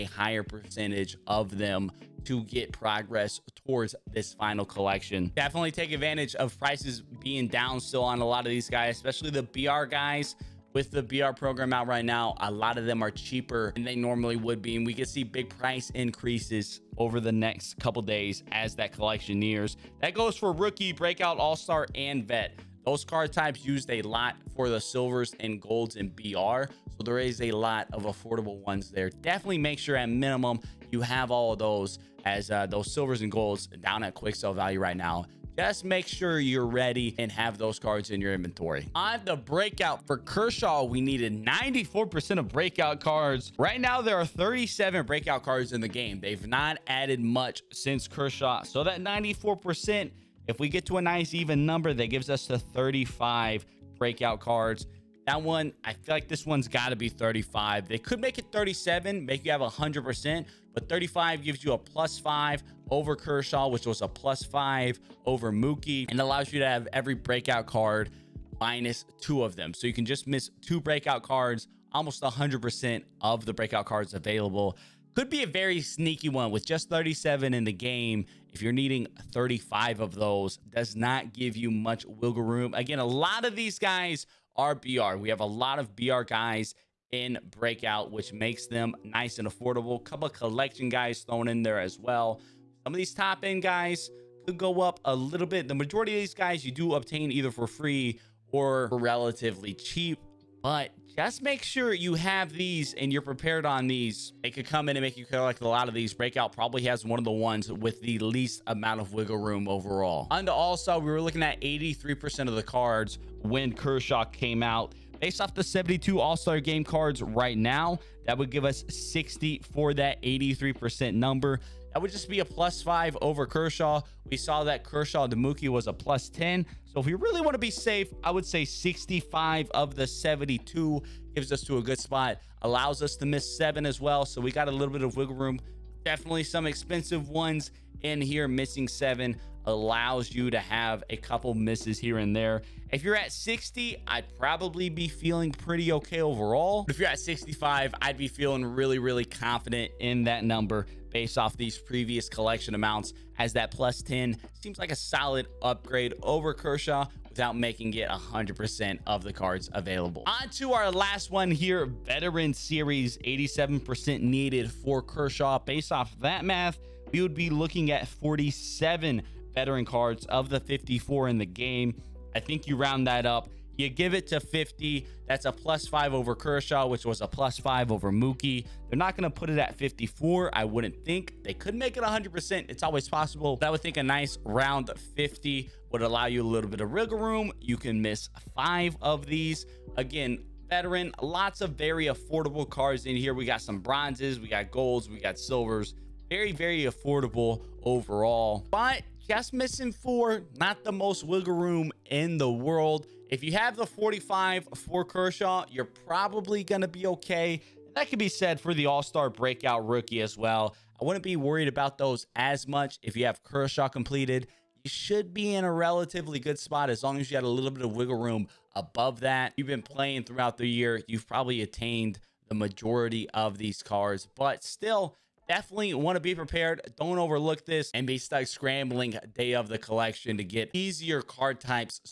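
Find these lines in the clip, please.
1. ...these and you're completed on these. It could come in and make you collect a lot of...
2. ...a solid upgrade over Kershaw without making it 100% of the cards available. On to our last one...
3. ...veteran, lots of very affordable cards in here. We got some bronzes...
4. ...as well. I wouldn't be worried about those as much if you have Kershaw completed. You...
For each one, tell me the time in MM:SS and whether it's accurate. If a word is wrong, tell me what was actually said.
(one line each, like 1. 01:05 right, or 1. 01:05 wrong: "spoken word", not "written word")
1. 01:42 wrong: "prepared", not "completed"
2. 02:34 right
3. 03:10 right
4. 03:30 right.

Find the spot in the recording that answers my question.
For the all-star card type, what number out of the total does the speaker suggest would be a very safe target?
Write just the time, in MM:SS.
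02:08.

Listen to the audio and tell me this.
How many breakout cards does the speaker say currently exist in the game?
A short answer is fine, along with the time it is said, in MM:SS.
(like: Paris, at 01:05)
37, at 00:44.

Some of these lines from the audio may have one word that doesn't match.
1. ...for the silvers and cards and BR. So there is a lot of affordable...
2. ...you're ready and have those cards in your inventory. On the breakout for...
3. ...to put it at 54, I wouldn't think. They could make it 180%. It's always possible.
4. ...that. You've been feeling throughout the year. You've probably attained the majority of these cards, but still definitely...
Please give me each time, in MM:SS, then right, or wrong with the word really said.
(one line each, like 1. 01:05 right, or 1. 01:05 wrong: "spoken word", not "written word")
1. 00:24 wrong: "golds", not "cards"
2. 00:36 right
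3. 02:59 wrong: "100", not "180"
4. 03:39 wrong: "playing", not "feeling".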